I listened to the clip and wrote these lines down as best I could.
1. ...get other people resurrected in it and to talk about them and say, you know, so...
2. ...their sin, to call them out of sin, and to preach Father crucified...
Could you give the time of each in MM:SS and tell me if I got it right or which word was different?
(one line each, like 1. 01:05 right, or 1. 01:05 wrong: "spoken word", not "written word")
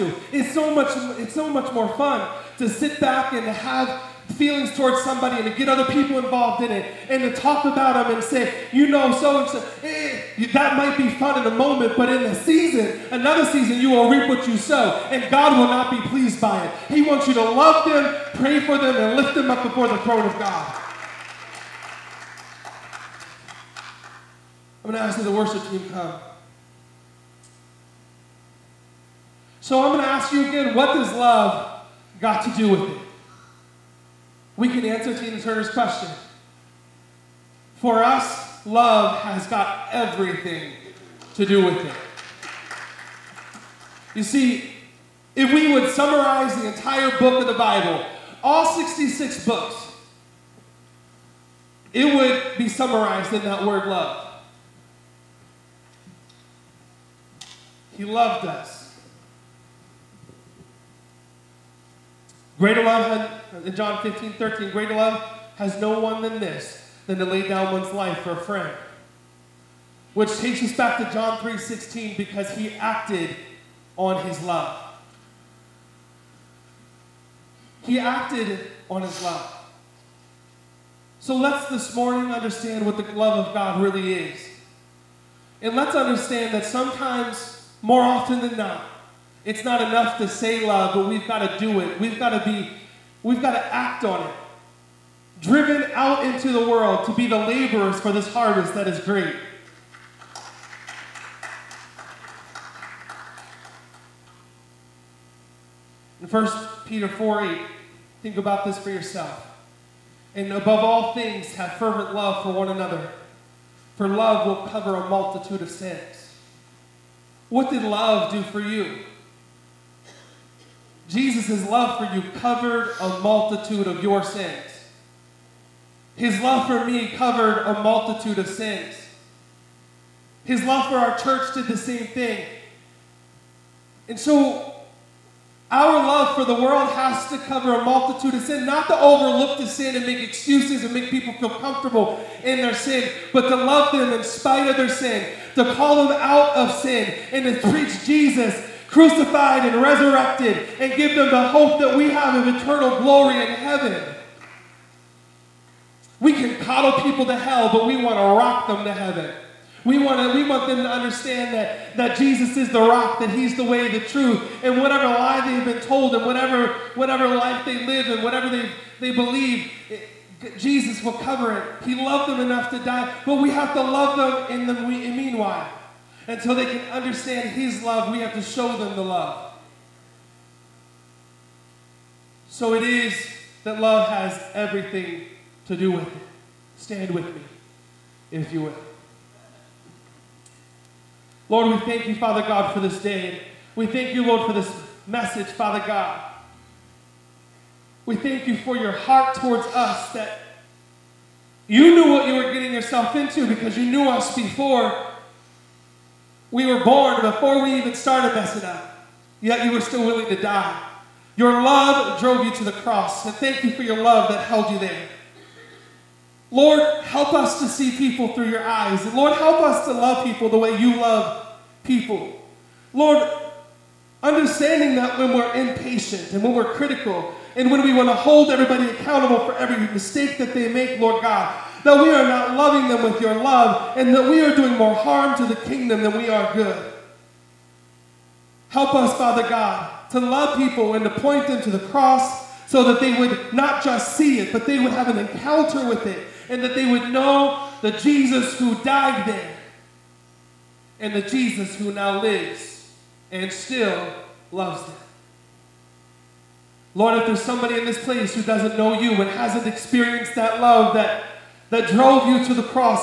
1. 00:05 wrong: "involved", not "resurrected"
2. 02:24 wrong: "Jesus", not "Father".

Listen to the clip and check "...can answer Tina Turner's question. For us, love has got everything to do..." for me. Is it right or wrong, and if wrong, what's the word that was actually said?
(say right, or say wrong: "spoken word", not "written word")
right.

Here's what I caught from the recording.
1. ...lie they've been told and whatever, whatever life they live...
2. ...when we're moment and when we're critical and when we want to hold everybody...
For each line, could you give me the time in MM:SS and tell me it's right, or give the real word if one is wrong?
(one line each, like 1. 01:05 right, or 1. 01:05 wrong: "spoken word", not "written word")
1. 02:45 right
2. 03:45 wrong: "impatient", not "moment".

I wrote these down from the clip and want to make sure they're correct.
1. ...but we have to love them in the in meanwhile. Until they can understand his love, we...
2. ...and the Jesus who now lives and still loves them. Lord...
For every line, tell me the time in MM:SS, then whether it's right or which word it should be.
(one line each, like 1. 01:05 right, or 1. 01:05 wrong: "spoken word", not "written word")
1. 02:53 right
2. 04:10 right.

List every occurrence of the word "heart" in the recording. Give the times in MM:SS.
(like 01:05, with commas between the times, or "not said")
03:18.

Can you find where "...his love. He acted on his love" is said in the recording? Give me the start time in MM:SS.
01:14.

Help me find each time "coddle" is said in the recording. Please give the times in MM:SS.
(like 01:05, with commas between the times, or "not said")
02:36.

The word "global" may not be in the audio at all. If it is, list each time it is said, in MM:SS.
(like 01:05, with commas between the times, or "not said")
not said.